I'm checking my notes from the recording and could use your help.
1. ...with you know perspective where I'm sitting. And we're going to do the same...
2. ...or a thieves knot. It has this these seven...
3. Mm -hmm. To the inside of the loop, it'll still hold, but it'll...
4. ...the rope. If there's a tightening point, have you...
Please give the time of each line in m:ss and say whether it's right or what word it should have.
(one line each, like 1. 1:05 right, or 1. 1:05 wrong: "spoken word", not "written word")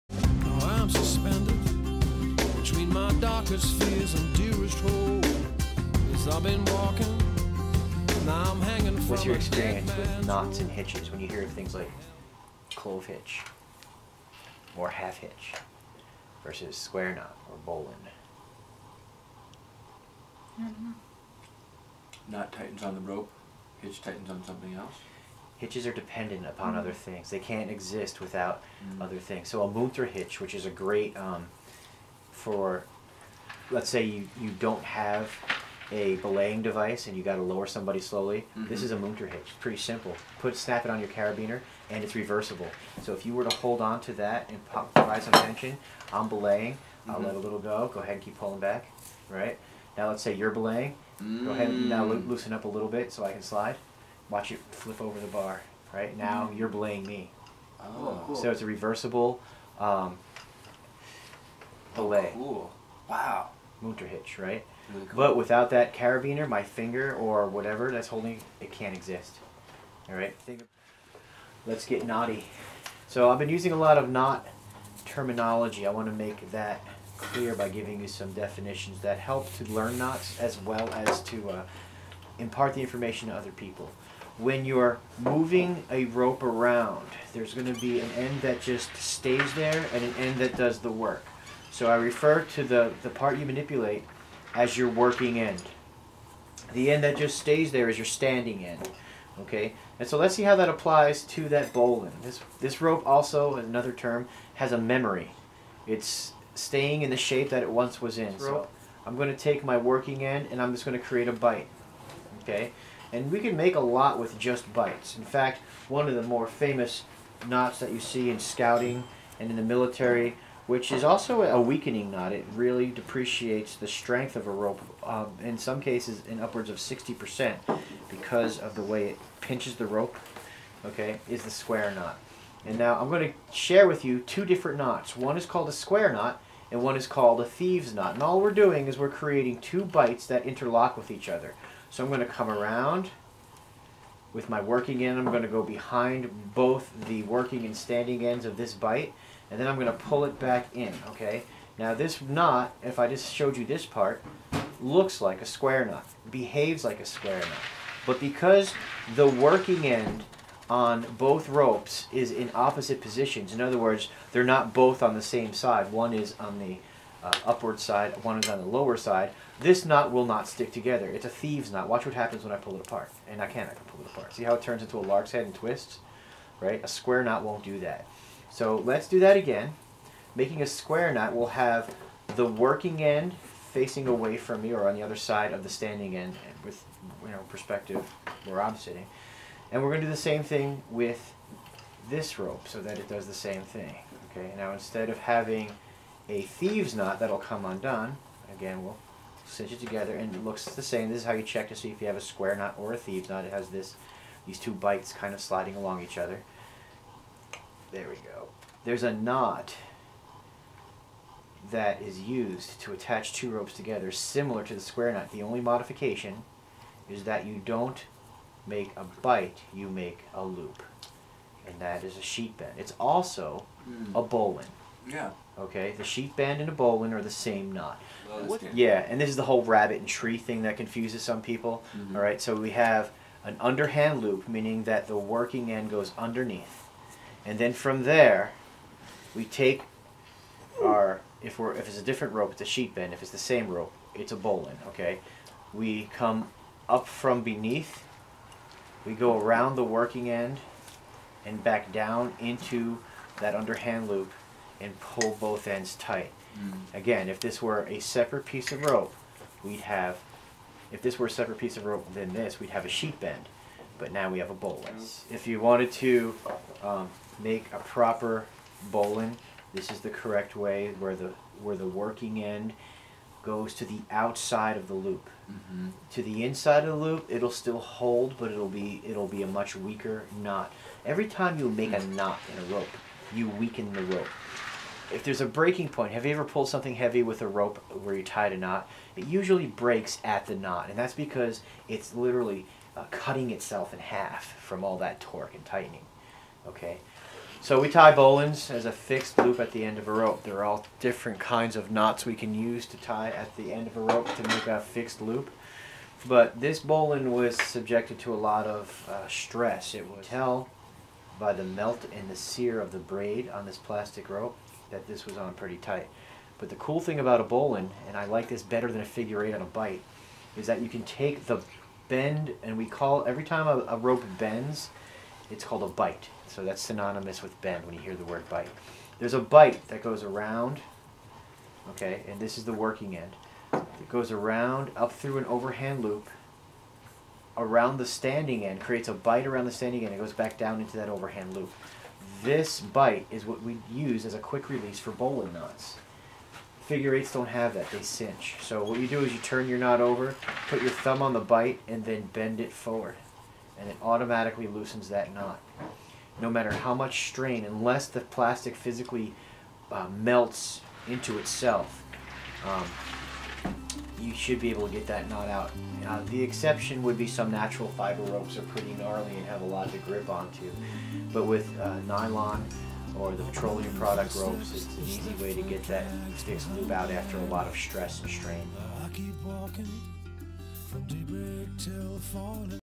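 1. 3:06 right
2. 3:22 wrong: "two", not "seven"
3. 4:35 right
4. 4:43 wrong: "breaking", not "tightening".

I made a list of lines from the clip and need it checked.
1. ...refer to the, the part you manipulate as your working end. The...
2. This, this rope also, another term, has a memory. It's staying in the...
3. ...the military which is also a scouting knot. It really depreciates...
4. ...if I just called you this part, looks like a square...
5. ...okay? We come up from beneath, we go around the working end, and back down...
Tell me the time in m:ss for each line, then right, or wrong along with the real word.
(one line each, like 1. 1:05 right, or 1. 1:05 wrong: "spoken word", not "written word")
1. 1:31 right
2. 1:42 right
3. 1:59 wrong: "weakening", not "scouting"
4. 2:32 wrong: "showed", not "called"
5. 4:04 right.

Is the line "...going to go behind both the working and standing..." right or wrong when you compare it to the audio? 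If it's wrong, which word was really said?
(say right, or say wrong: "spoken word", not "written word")
right.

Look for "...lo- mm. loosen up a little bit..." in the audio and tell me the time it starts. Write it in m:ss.
0:52.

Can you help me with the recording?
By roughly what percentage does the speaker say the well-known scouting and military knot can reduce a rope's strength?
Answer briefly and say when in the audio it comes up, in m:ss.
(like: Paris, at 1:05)
60%, at 2:06.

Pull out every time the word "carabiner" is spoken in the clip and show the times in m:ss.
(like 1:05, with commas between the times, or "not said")
0:41, 1:05.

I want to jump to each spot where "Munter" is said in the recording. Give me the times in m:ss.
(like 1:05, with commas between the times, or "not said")
0:29, 0:38.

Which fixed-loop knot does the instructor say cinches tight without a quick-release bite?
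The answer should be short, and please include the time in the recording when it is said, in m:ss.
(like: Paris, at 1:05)
figure eight on a bite, at 5:19.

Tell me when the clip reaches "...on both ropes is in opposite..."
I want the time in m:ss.
2:40.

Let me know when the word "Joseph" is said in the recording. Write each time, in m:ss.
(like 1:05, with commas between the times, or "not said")
not said.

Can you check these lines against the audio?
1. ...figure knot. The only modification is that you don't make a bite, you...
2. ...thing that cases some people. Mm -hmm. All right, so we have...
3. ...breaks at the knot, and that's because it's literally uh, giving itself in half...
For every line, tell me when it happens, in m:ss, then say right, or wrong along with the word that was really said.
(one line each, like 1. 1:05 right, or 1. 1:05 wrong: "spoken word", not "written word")
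1. 3:34 wrong: "square", not "figure"
2. 3:50 wrong: "confuses", not "cases"
3. 4:49 wrong: "cutting", not "giving".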